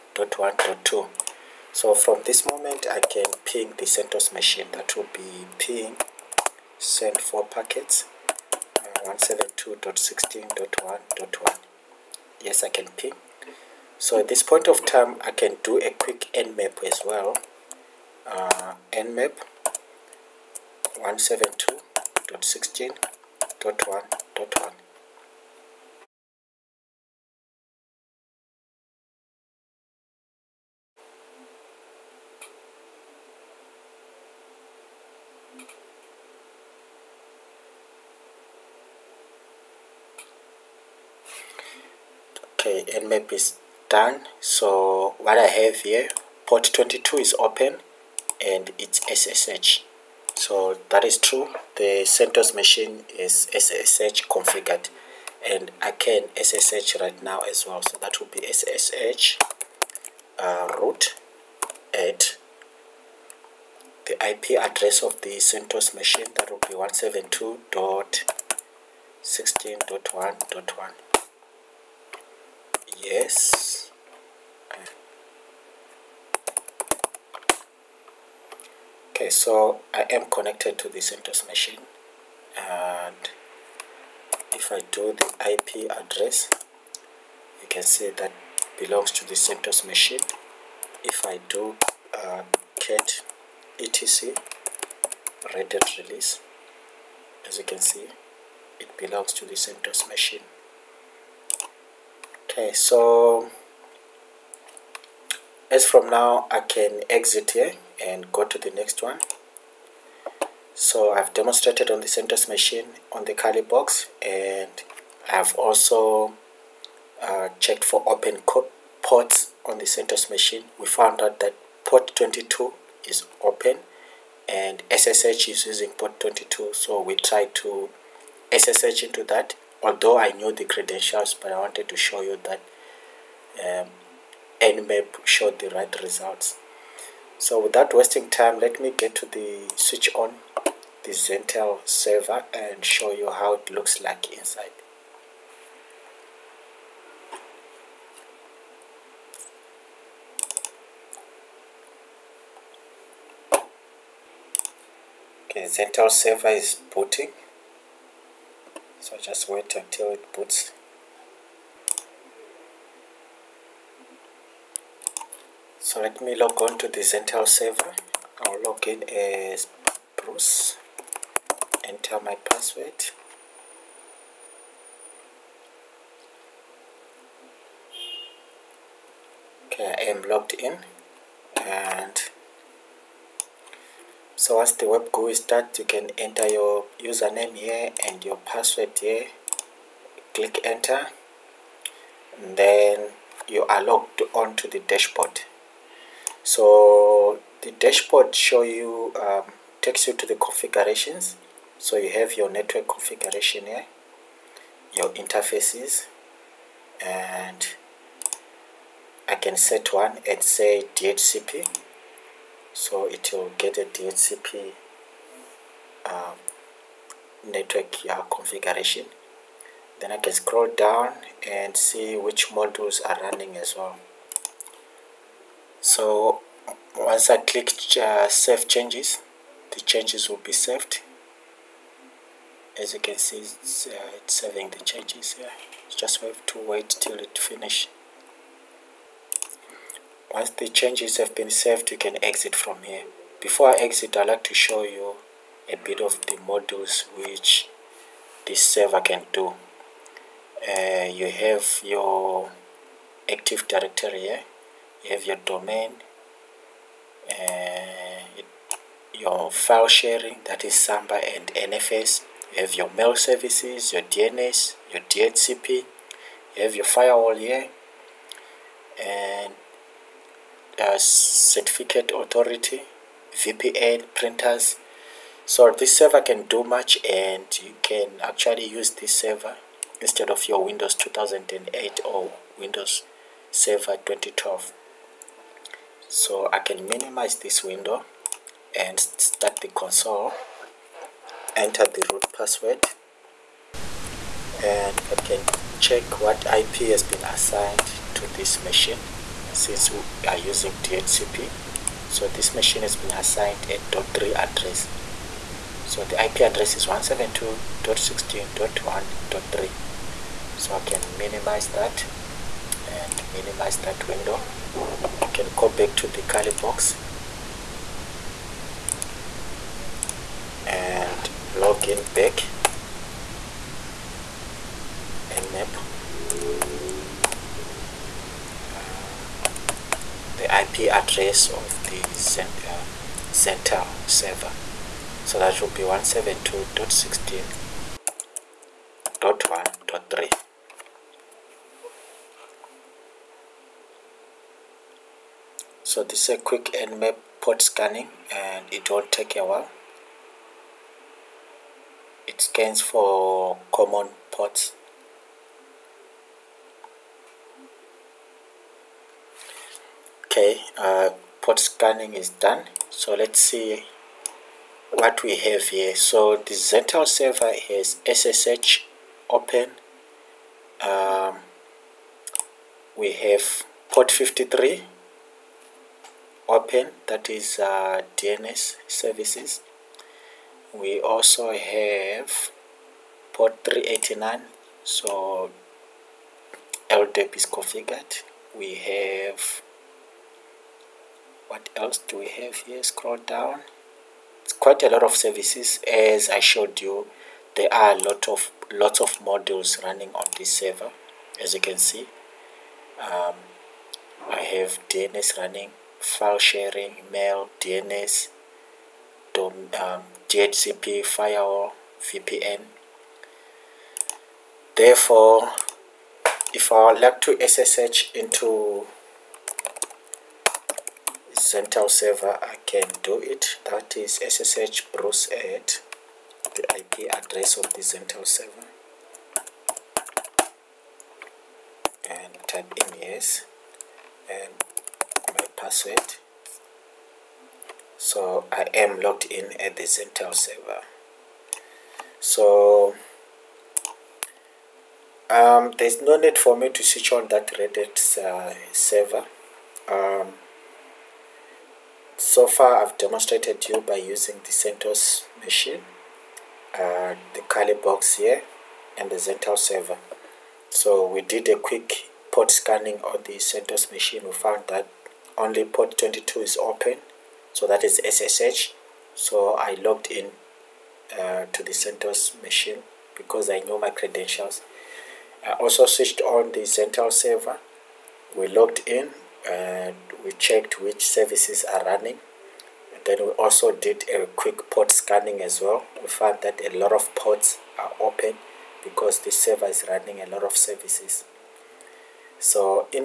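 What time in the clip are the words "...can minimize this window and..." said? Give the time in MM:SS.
04:46.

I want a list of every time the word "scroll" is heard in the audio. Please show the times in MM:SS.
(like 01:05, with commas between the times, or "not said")
03:40, 06:32.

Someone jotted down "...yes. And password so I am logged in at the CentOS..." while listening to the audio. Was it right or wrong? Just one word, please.
right.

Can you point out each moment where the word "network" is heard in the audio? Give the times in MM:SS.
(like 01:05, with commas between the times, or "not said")
03:22, 03:37.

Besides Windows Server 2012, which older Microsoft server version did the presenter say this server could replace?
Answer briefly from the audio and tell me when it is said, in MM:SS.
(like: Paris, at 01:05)
Windows 2008, at 04:40.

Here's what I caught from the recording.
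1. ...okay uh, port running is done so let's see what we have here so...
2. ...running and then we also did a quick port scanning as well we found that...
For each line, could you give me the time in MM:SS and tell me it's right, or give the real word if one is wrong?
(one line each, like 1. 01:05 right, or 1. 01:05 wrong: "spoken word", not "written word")
1. 06:00 wrong: "scanning", not "running"
2. 08:01 right.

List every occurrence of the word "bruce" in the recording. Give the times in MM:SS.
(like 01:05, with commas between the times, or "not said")
02:50, 07:04.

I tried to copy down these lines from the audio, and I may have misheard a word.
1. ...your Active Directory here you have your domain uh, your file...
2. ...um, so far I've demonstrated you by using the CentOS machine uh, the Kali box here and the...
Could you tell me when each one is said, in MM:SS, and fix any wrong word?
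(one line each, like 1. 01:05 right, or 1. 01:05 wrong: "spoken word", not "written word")
1. 04:11 right
2. 07:29 right.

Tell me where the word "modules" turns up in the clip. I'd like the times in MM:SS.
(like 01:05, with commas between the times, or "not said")
03:42, 04:06, 06:39.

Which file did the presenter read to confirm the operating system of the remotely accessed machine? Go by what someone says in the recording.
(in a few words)
etc redhat release.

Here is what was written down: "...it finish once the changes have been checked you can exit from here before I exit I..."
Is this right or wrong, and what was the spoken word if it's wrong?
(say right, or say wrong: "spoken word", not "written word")
wrong: "saved", not "checked".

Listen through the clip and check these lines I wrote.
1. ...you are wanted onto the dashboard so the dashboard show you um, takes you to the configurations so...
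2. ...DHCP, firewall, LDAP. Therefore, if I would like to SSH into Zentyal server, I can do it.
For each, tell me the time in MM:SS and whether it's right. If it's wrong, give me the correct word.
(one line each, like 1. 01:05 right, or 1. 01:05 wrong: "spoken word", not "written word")
1. 03:13 wrong: "logged", not "wanted"
2. 06:50 wrong: "VPN", not "LDAP".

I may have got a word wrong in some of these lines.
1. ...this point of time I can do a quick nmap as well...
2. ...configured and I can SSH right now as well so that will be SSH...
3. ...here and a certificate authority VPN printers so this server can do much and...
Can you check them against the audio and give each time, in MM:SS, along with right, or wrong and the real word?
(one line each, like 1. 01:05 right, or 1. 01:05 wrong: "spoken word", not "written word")
1. 00:14 right
2. 00:54 right
3. 04:27 right.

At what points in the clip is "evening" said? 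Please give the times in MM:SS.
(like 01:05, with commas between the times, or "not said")
not said.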